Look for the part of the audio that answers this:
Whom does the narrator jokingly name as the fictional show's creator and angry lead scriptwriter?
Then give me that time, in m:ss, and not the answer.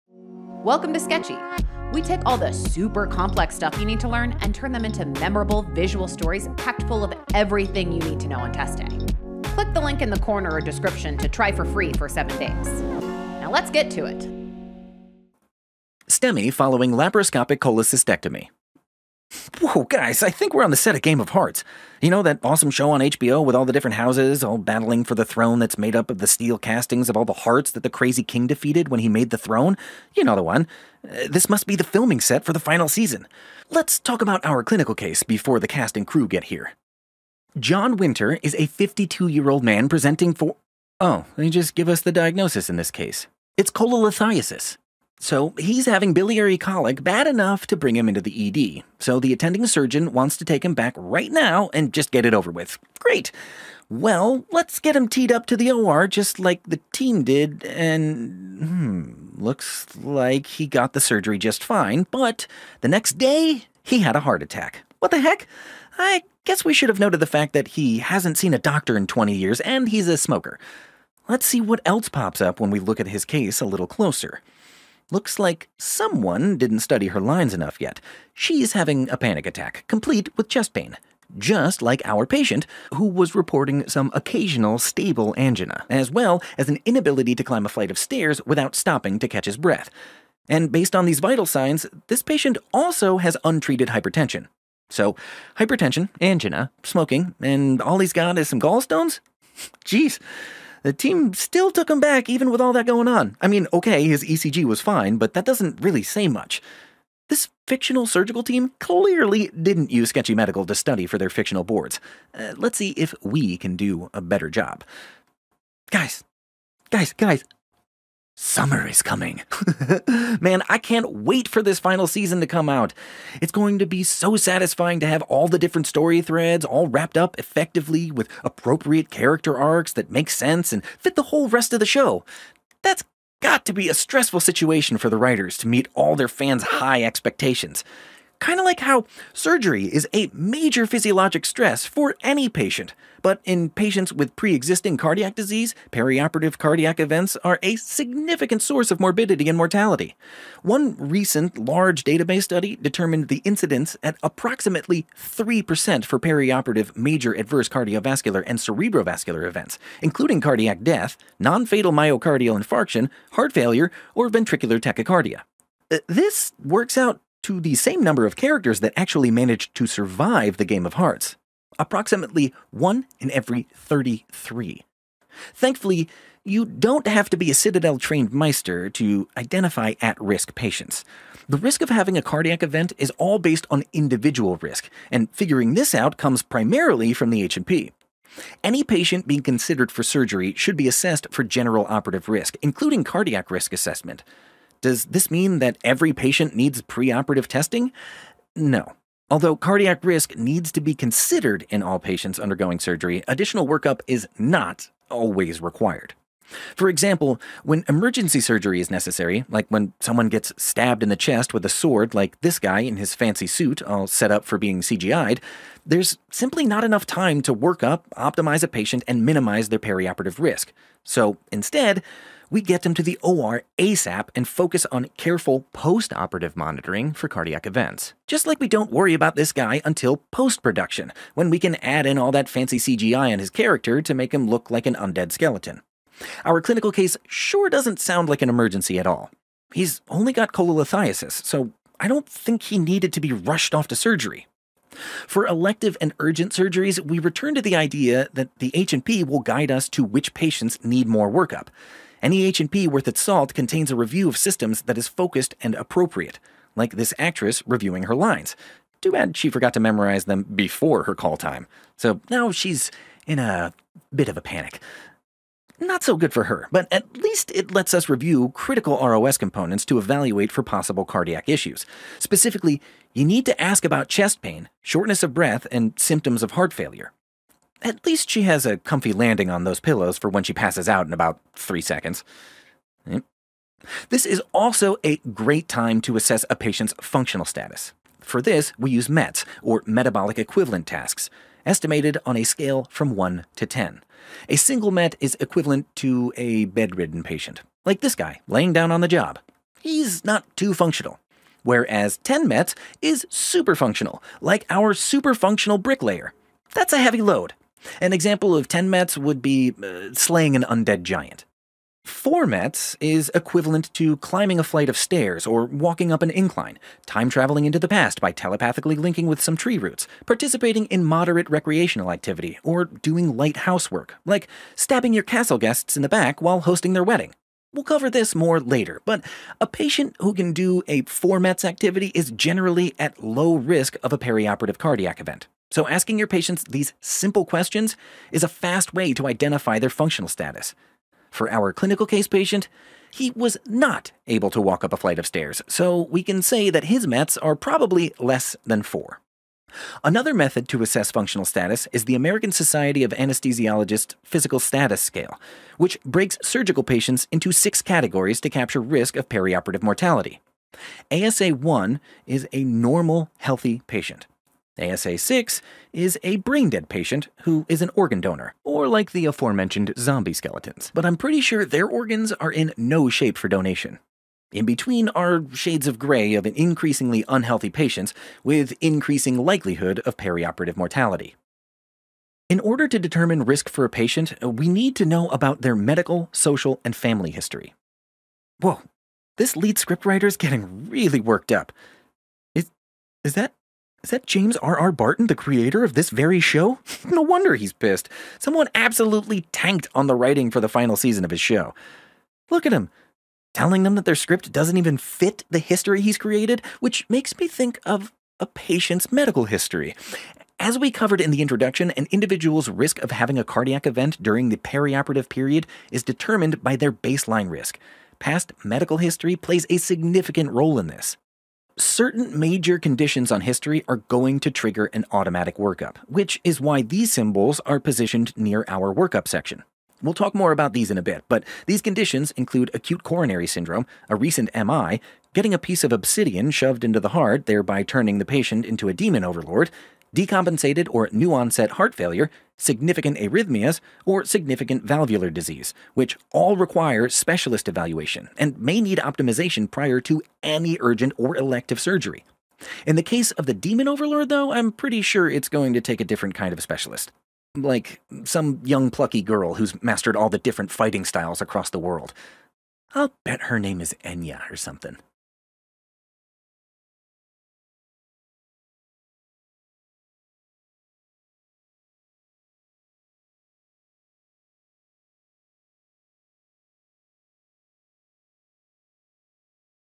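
6:34.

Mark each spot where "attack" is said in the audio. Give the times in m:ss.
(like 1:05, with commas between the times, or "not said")
1:04, 1:19.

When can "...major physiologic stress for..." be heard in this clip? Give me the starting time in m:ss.
2:20.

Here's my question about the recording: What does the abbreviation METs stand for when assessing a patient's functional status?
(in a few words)
metabolic equivalent tasks.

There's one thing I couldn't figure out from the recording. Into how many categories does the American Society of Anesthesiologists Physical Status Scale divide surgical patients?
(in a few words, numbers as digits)
6.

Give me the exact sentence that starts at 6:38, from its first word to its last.
Someone absolutely tanked on the writing for the final season of his show.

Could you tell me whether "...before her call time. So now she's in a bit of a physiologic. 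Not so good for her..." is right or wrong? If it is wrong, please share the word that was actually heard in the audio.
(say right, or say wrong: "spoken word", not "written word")
wrong: "panic", not "physiologic".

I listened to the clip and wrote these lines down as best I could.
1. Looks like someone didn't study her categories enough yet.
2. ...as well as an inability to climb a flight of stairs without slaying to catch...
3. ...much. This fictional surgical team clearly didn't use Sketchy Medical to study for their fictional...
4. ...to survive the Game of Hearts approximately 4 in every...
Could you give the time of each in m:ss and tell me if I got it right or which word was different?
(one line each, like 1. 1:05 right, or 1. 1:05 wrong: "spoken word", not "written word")
1. 1:15 wrong: "lines", not "categories"
2. 1:25 wrong: "stopping", not "slaying"
3. 1:46 right
4. 2:49 wrong: "1", not "4".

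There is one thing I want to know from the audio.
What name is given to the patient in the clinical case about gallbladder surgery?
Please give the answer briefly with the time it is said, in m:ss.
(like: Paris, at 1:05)
John Winter, at 0:37.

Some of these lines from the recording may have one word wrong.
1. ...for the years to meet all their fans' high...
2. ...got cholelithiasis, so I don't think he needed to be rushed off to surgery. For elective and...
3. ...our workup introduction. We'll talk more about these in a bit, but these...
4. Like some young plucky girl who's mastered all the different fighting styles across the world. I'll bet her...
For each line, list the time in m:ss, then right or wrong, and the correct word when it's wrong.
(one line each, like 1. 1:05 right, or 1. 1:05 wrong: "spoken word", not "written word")
1. 2:14 wrong: "writers", not "years"
2. 4:00 right
3. 7:08 wrong: "section", not "introduction"
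4. 7:37 right.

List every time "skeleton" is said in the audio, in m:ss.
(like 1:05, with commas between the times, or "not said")
3:55, 6:10.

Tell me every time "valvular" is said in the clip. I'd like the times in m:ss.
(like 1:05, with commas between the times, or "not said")
7:24.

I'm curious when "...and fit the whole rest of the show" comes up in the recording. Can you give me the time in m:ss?
2:10.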